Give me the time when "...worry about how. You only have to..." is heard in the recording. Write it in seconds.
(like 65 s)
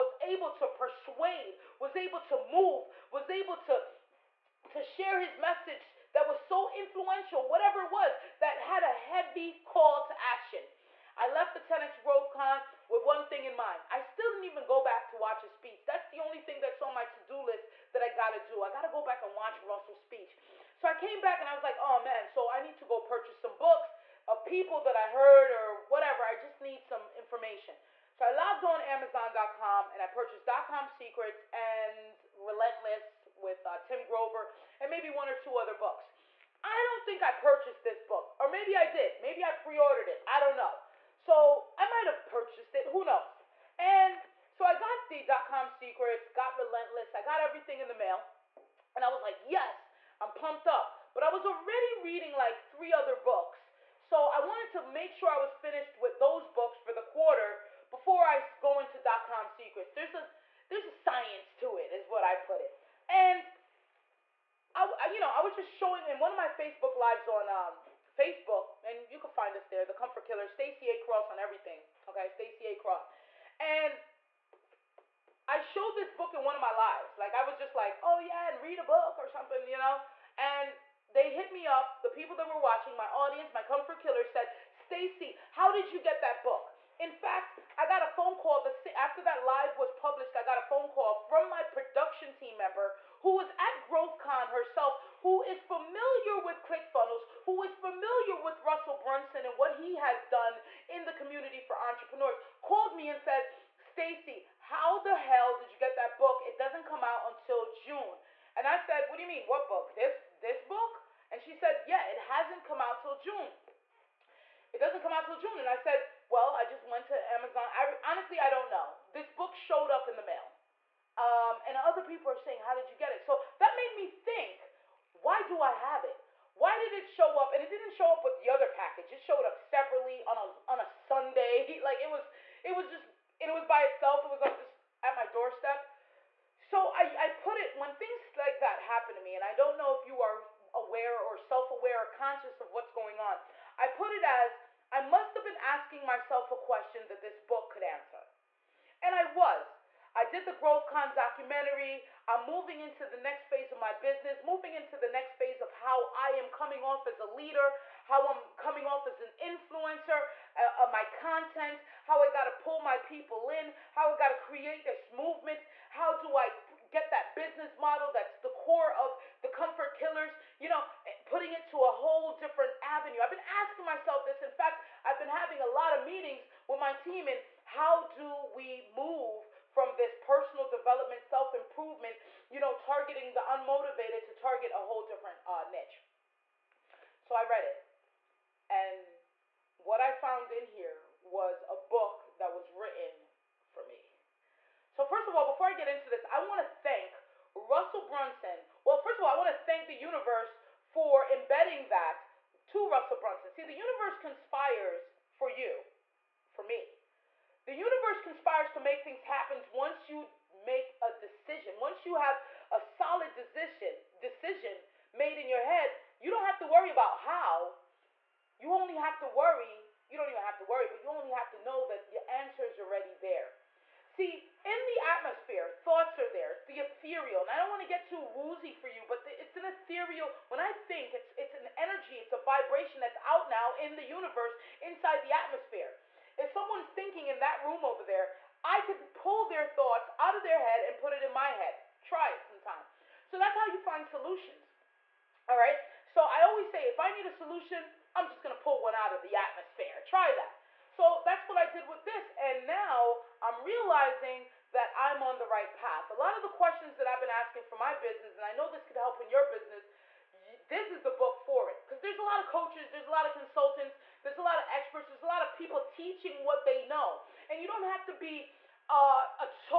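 216 s.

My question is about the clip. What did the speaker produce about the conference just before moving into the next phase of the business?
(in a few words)
Growth Con documentary.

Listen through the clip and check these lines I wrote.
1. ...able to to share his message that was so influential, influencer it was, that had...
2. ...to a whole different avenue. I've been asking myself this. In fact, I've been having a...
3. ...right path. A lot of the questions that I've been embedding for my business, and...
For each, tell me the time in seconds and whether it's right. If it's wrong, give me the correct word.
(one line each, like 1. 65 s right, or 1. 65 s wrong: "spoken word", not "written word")
1. 3 s wrong: "whatever", not "influencer"
2. 171 s right
3. 255 s wrong: "asking", not "embedding".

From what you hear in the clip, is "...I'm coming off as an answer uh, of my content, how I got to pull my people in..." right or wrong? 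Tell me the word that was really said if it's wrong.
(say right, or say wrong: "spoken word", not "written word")
wrong: "influencer", not "answer".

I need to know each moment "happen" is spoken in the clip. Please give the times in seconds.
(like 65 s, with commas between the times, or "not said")
138 s, 209 s.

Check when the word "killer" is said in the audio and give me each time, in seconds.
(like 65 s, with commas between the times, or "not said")
70 s, 84 s, 169 s.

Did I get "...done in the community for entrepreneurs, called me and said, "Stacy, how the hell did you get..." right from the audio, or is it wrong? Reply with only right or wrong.
right.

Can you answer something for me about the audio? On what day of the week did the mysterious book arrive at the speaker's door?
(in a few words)
Sunday.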